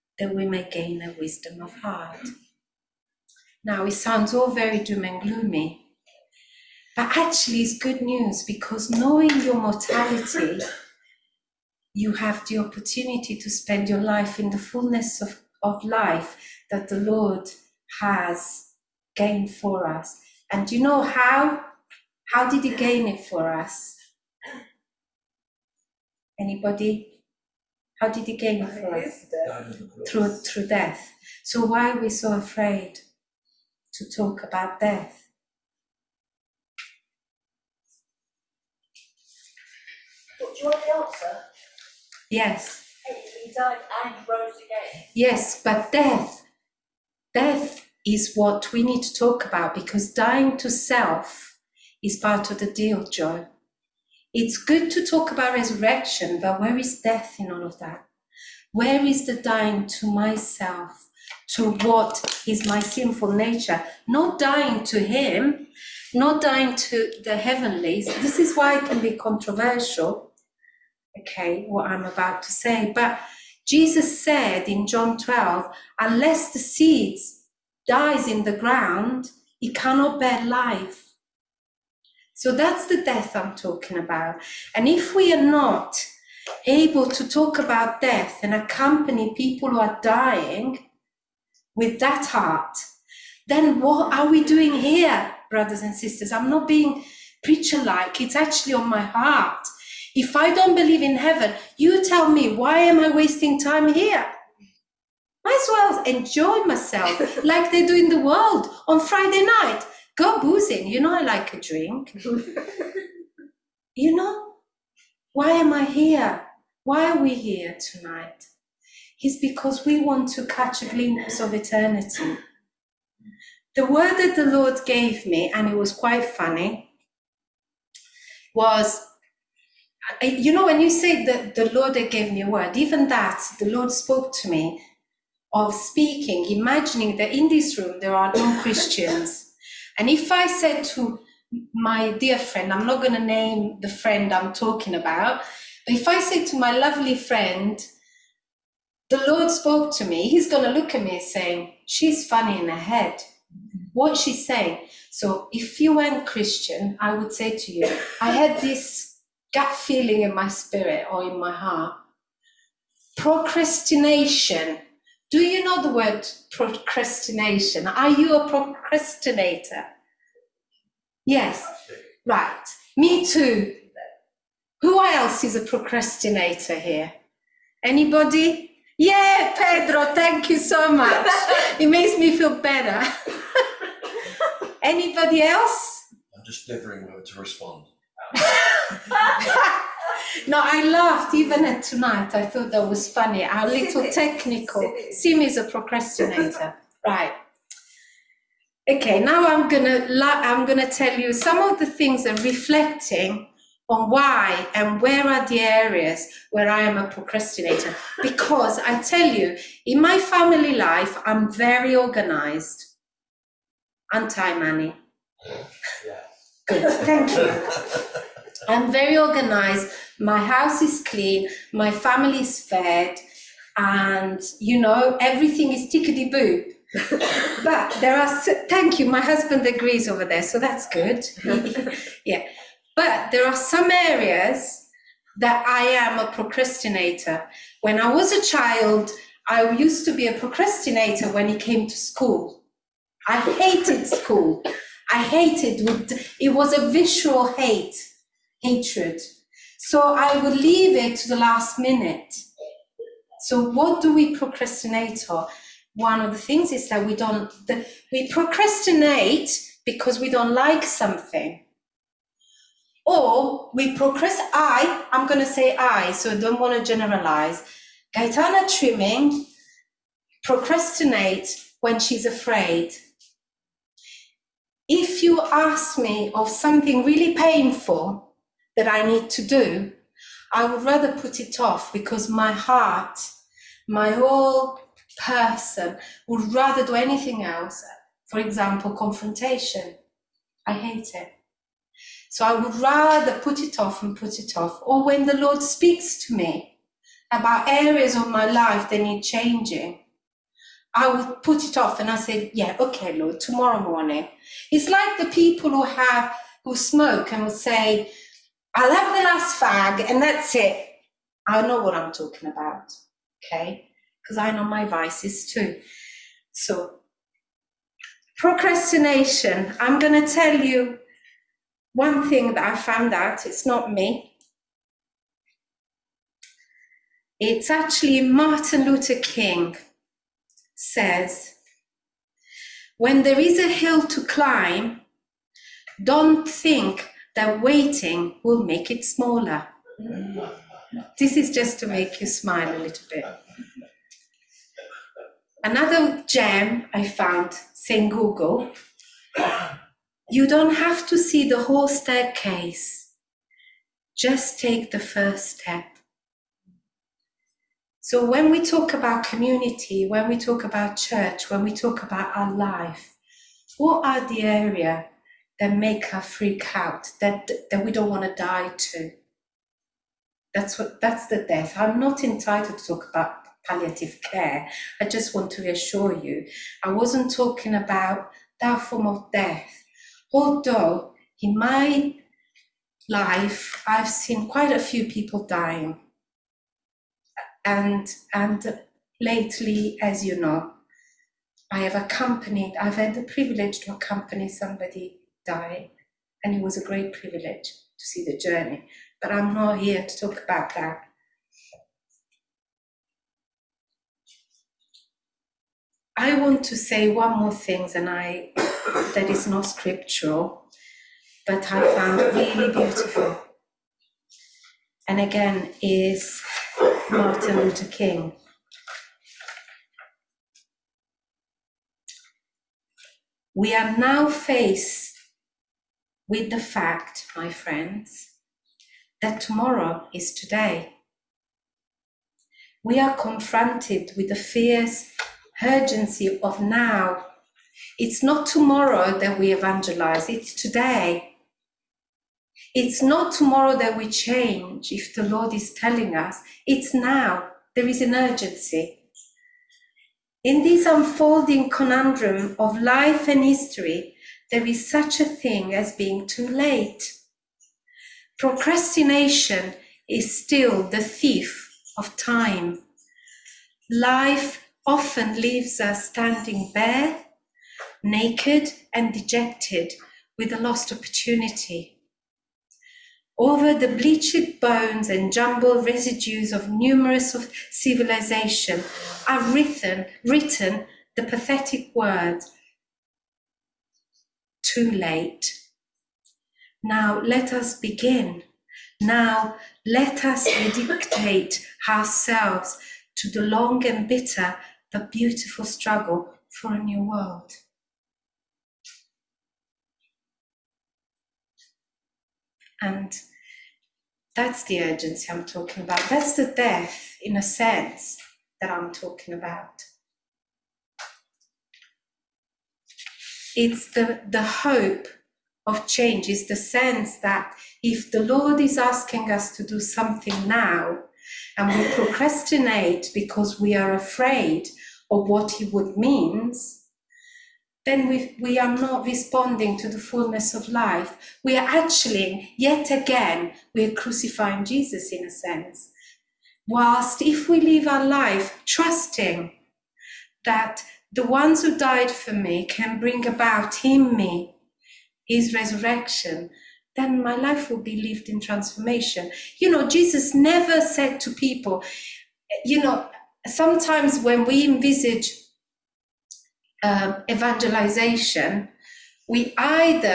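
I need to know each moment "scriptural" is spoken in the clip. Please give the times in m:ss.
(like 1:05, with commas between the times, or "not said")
6:49.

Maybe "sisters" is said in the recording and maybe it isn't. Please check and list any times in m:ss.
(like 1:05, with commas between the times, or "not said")
1:35.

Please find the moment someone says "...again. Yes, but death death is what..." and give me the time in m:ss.
0:44.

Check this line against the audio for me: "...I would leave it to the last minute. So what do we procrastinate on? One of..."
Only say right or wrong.
right.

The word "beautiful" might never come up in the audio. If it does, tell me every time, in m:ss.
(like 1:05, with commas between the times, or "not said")
6:52, 8:15.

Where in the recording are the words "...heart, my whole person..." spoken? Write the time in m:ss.
4:42.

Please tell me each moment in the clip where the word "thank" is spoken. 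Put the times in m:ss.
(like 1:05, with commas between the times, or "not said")
3:00, 3:37, 3:48.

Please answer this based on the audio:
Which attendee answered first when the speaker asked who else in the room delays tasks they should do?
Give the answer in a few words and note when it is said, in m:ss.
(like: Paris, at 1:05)
Pedro, at 2:59.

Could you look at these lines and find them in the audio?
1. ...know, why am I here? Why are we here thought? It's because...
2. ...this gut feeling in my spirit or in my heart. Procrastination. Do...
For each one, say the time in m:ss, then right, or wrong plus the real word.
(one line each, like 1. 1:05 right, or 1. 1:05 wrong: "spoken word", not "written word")
1. 1:54 wrong: "tonight", not "thought"
2. 2:38 right.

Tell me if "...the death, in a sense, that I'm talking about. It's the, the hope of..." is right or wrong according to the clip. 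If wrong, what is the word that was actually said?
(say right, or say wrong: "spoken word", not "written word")
right.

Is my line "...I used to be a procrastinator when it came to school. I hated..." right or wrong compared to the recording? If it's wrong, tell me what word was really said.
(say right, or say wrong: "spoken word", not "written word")
right.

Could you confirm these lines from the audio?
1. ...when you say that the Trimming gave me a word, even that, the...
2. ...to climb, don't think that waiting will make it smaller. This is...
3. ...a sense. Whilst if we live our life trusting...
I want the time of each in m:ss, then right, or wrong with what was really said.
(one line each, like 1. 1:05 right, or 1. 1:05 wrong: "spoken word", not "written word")
1. 2:10 wrong: "Lord", not "Trimming"
2. 5:34 right
3. 8:55 right.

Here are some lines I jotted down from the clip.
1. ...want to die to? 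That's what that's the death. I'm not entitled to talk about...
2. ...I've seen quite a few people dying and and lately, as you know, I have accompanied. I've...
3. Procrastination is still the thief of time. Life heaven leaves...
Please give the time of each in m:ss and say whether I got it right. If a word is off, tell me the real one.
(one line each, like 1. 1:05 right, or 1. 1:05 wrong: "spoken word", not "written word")
1. 6:08 right
2. 6:23 right
3. 7:38 wrong: "often", not "heaven".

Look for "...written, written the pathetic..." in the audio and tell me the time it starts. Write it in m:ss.
7:59.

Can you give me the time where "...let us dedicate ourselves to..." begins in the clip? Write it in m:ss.
8:09.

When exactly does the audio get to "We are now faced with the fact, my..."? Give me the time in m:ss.
7:03.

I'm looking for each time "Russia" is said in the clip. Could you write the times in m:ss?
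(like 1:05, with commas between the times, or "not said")
not said.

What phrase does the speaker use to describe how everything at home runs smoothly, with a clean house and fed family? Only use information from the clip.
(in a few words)
tickety boo.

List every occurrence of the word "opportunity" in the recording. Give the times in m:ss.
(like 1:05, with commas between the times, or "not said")
0:12, 7:50.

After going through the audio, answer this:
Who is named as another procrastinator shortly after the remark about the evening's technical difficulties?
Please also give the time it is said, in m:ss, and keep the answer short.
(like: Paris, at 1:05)
Sim, at 3:15.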